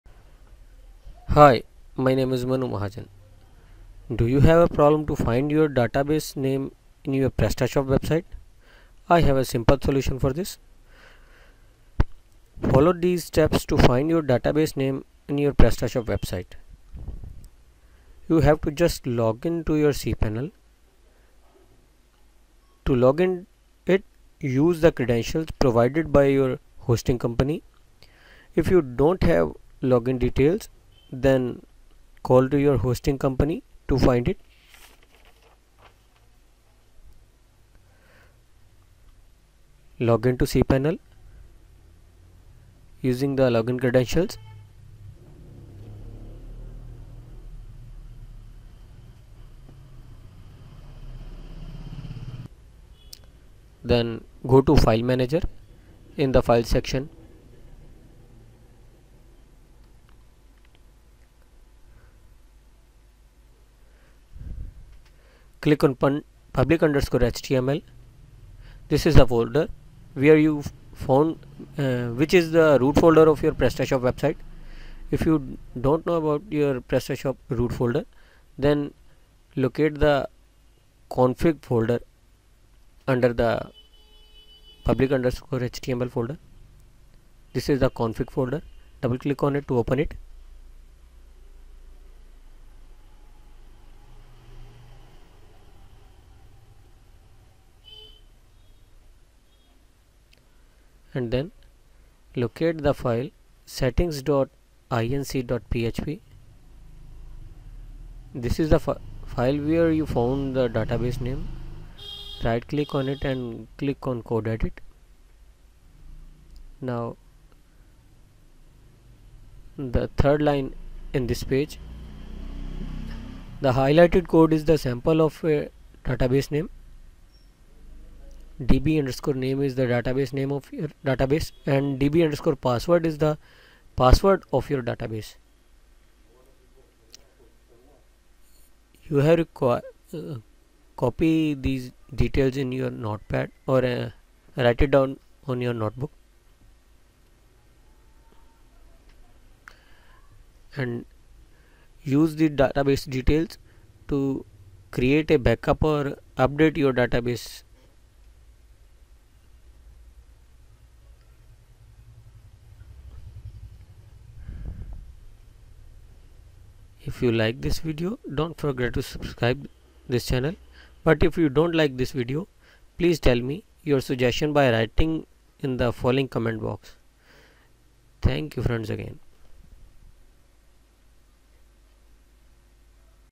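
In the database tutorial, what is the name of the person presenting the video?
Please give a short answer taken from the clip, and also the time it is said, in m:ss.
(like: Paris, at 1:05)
Manu Mahajan, at 0:02.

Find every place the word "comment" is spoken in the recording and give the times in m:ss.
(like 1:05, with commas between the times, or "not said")
2:56.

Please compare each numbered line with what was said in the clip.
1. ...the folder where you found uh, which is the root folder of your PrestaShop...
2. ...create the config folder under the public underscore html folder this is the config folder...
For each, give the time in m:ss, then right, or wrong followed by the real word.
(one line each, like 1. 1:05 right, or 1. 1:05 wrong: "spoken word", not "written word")
1. 1:09 right
2. 1:19 wrong: "locate", not "create".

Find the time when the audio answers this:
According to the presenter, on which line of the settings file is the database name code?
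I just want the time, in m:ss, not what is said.
2:00.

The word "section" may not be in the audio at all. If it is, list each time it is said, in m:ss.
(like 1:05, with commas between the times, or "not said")
0:56.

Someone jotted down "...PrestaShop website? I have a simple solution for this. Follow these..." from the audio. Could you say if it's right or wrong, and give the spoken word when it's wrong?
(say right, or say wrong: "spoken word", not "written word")
right.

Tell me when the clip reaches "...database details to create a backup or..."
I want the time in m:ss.
2:32.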